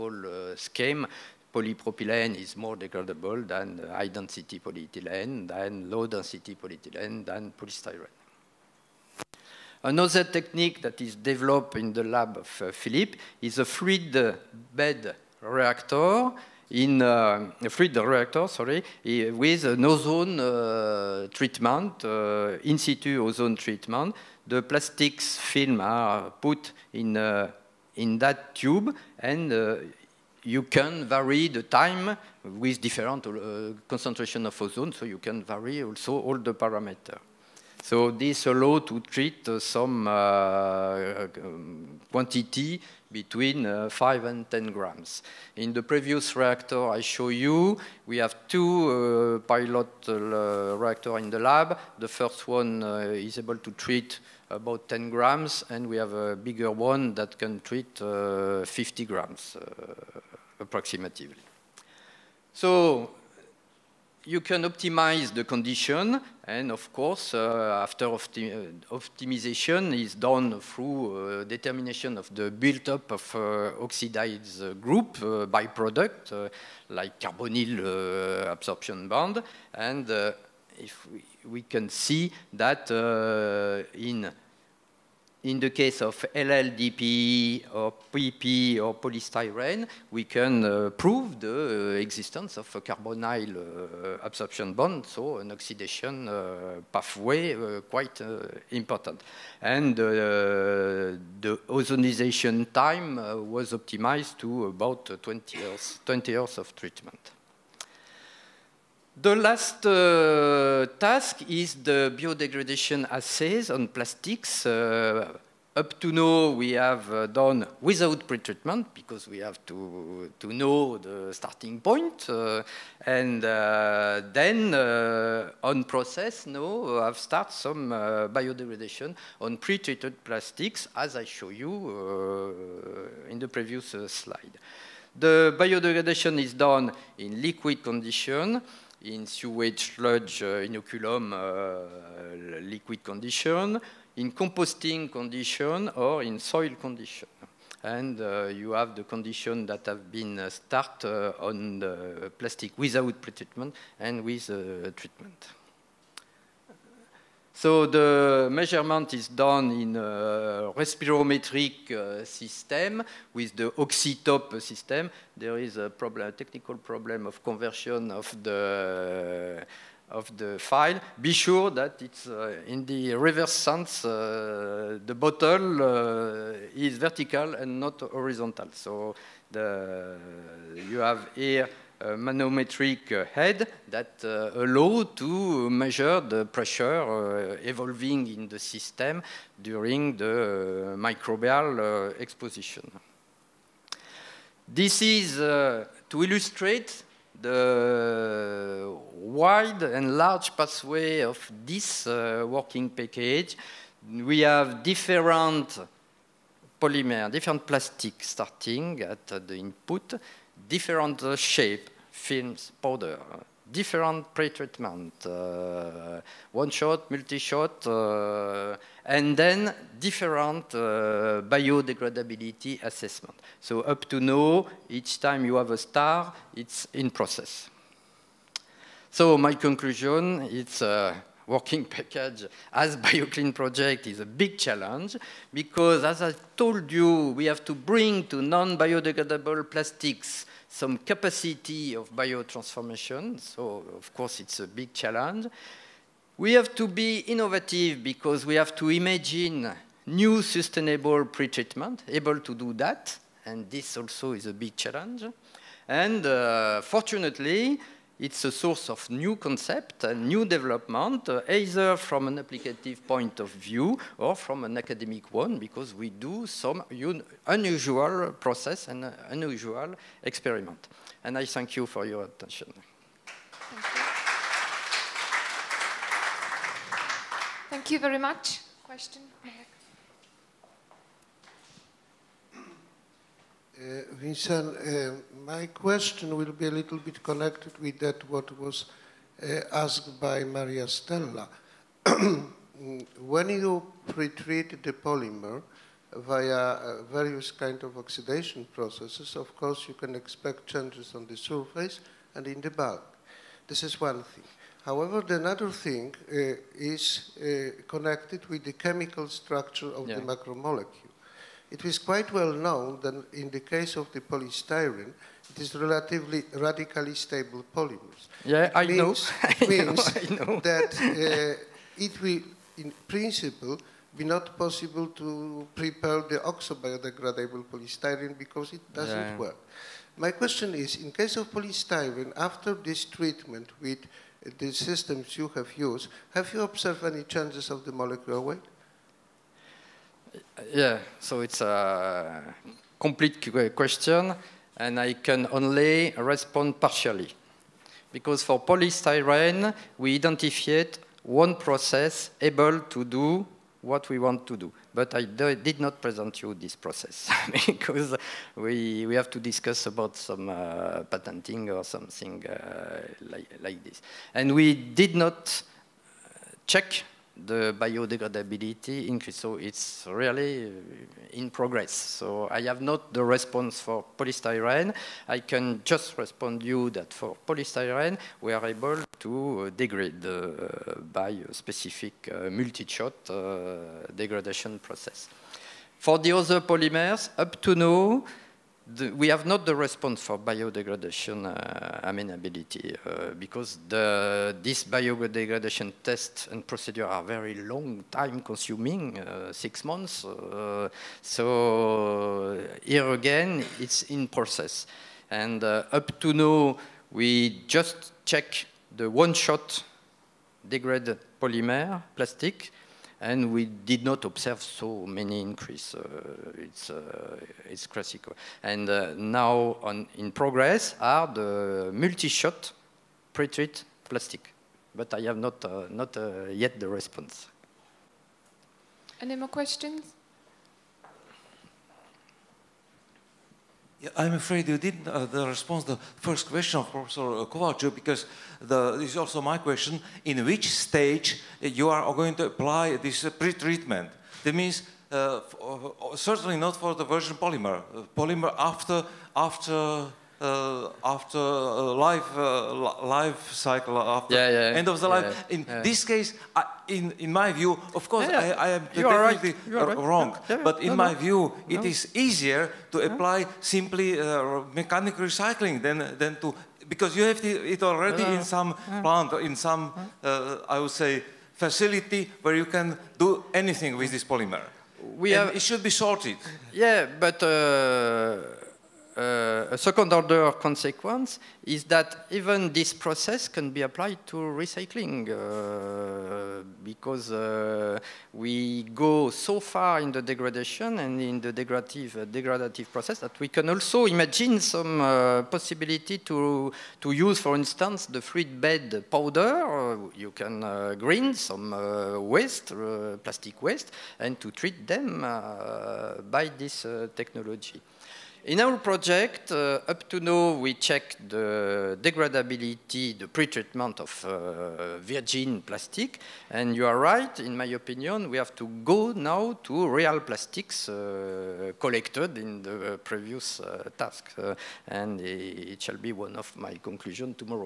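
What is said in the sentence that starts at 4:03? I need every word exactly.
So, of course, it's a big challenge.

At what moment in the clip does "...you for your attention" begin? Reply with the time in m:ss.
4:31.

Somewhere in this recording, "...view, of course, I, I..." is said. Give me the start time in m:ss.
7:37.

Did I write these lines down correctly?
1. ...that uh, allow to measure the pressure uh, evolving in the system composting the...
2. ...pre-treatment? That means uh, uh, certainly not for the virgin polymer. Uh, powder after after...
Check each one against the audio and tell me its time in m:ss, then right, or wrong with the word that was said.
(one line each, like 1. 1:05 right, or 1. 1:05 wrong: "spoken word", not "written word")
1. 3:03 wrong: "during", not "composting"
2. 7:23 wrong: "polymer", not "powder".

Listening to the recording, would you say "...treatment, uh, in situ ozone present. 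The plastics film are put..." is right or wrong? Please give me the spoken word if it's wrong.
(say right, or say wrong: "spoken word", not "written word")
wrong: "treatment", not "present".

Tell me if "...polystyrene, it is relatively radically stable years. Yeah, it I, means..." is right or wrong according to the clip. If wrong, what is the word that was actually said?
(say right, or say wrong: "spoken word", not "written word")
wrong: "polymers", not "years".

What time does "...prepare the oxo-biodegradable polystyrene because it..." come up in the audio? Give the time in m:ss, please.
5:25.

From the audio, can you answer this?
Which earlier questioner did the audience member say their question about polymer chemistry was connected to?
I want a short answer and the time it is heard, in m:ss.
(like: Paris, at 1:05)
Maria Stella, at 4:50.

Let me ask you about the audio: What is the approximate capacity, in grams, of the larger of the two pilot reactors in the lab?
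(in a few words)
50 grams.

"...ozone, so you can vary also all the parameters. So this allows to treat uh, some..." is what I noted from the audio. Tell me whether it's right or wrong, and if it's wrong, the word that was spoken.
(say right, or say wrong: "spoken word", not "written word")
right.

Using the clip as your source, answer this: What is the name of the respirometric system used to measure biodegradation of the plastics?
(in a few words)
OxiTop.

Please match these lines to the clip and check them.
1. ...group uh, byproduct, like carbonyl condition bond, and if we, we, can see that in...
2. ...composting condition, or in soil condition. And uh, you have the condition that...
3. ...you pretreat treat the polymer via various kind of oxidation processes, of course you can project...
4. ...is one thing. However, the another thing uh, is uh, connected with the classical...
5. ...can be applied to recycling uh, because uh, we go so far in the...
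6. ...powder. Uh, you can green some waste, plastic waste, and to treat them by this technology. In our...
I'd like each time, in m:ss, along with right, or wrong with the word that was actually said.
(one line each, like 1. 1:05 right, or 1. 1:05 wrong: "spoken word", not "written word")
1. 1:14 wrong: "absorption", not "condition"
2. 2:24 right
3. 4:53 wrong: "expect", not "project"
4. 5:03 wrong: "chemical", not "classical"
5. 8:03 right
6. 8:19 right.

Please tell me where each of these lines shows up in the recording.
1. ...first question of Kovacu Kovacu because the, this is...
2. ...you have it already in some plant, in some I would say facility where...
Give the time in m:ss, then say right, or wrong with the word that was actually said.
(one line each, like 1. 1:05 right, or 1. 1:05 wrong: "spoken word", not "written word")
1. 7:16 wrong: "Professor", not "Kovacu"
2. 7:47 right.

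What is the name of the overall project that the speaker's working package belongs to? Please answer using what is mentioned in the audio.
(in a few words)
BioClean.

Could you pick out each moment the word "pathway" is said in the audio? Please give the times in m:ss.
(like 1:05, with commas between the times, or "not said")
1:36, 3:20.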